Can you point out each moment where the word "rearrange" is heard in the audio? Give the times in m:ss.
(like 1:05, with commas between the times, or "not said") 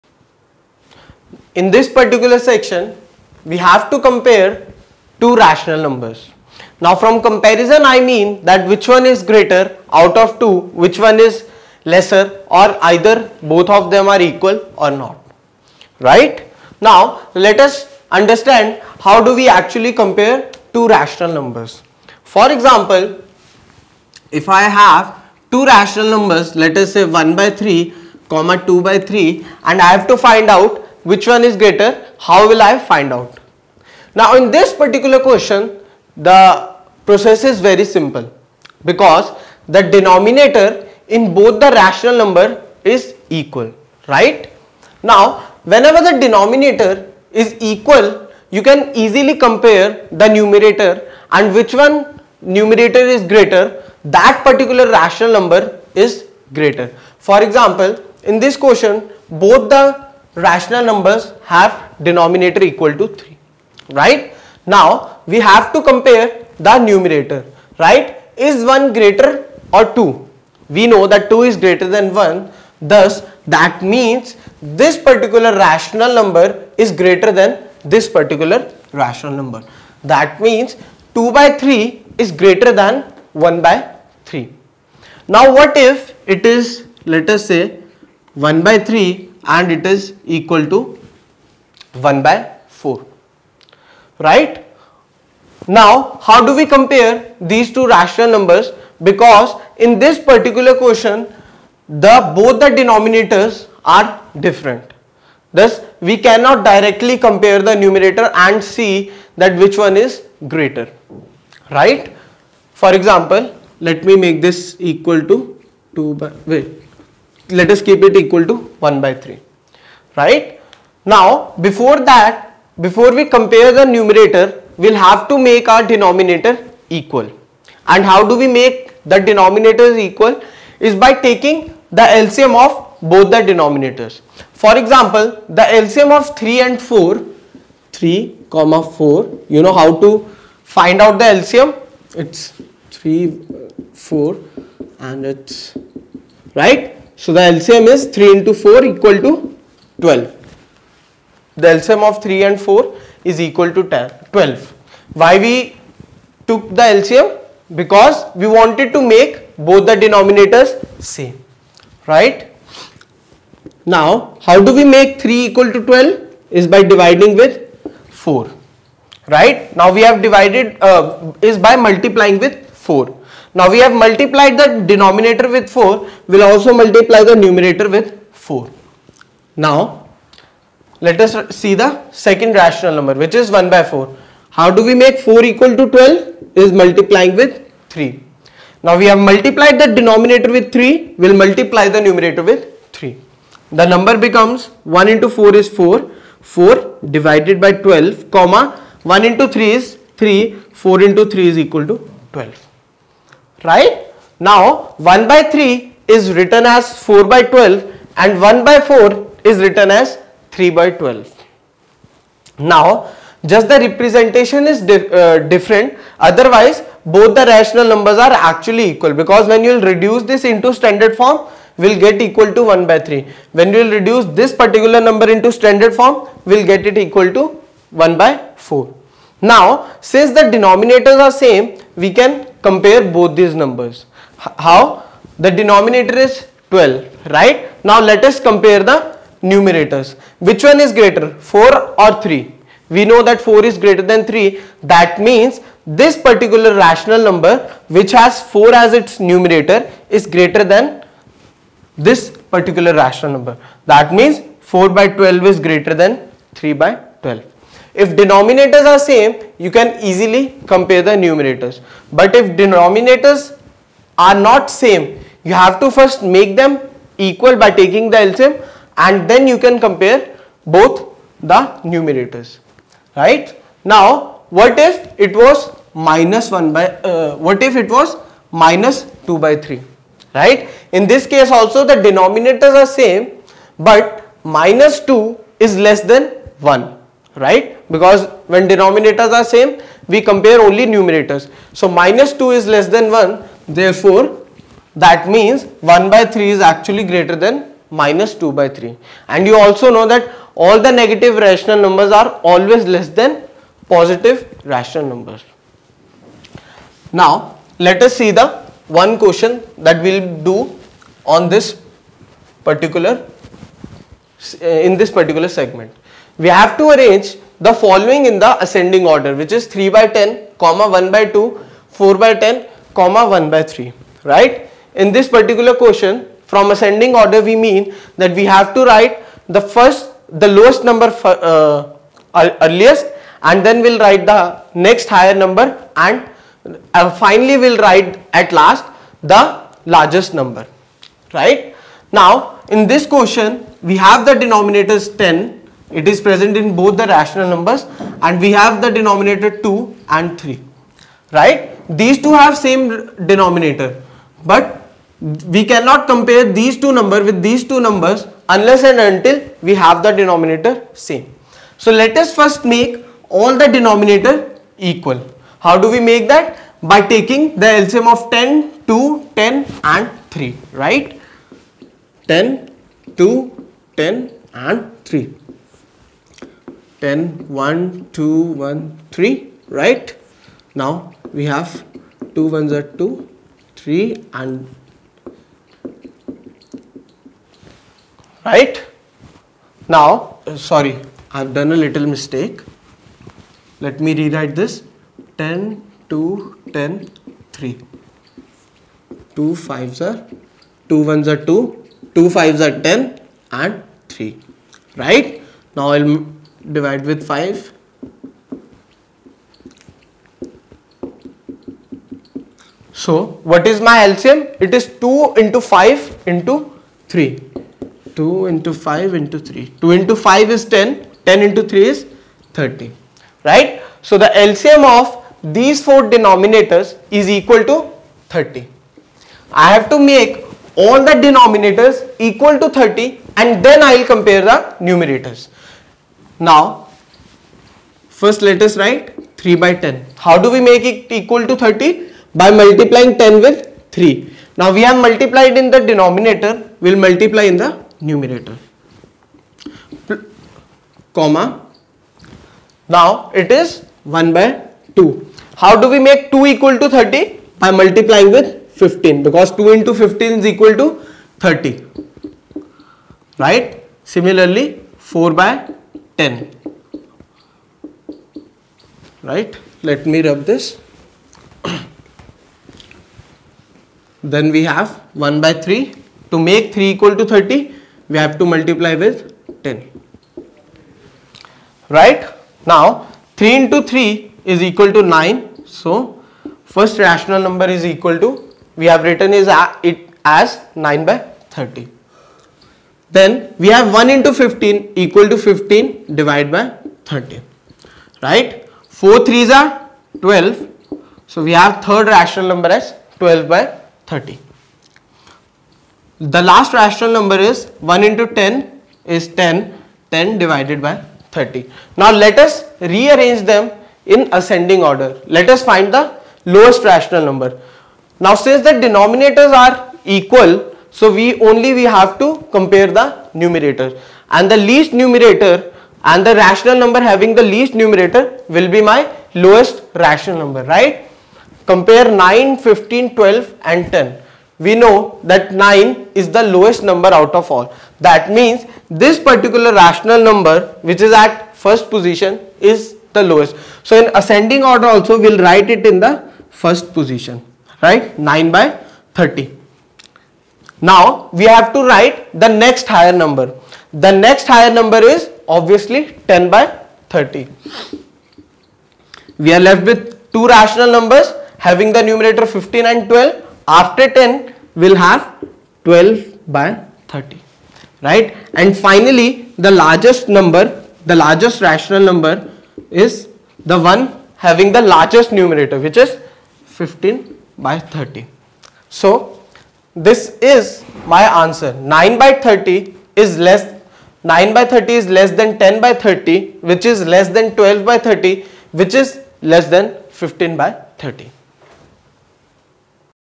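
8:32.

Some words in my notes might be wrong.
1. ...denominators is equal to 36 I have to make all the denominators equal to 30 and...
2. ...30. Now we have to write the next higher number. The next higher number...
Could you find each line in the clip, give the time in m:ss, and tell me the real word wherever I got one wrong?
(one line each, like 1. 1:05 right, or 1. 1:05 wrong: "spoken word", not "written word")
1. 7:06 wrong: "30", not "36"
2. 9:09 right.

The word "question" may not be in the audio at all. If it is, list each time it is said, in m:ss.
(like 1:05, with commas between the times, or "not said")
0:35, 0:58, 1:40, 5:09, 5:25, 5:43.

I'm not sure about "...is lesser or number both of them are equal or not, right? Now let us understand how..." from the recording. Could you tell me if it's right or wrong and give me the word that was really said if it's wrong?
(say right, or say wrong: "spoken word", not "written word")
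wrong: "either", not "number".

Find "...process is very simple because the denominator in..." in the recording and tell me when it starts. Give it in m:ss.
0:37.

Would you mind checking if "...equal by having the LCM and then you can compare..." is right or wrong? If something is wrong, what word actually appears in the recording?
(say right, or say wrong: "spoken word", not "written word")
wrong: "taking", not "having".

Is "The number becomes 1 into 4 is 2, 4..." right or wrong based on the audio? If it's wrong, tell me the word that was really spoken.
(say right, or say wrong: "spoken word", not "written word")
wrong: "4", not "2".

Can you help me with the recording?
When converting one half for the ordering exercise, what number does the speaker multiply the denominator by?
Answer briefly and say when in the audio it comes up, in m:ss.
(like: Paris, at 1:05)
15, at 7:37.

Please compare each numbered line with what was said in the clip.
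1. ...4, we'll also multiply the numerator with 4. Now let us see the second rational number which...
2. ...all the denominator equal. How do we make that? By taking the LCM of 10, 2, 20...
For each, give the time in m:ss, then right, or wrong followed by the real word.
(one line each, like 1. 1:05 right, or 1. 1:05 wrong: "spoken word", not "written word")
1. 2:55 right
2. 6:03 wrong: "10", not "20".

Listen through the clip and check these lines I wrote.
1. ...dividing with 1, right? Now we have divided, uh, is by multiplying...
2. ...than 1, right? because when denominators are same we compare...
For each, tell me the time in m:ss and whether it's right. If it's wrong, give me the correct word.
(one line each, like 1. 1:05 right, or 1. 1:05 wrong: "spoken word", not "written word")
1. 2:46 wrong: "4", not "1"
2. 4:46 right.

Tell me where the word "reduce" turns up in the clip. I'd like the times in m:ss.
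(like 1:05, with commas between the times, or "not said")
3:39, 3:43.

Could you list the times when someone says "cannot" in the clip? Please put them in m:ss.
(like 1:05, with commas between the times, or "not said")
1:46, 5:55.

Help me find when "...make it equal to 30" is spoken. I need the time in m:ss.
7:20.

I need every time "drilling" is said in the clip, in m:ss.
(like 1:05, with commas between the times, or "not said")
not said.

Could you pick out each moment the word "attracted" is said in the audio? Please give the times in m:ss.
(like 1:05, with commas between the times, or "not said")
not said.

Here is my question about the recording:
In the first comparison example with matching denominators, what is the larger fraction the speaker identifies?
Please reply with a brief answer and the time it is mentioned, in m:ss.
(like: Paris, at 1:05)
2/3, at 1:21.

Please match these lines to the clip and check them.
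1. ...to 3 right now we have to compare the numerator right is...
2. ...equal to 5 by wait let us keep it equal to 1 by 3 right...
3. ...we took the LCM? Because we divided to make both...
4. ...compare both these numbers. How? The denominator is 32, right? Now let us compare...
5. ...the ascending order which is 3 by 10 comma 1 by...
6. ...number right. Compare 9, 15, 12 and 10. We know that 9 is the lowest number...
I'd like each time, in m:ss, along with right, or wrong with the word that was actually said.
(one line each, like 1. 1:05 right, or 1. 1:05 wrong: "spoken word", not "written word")
1. 1:02 right
2. 1:54 wrong: "2", not "5"
3. 2:35 wrong: "wanted", not "divided"
4. 3:52 wrong: "12", not "32"
5. 5:18 right
6. 8:50 right.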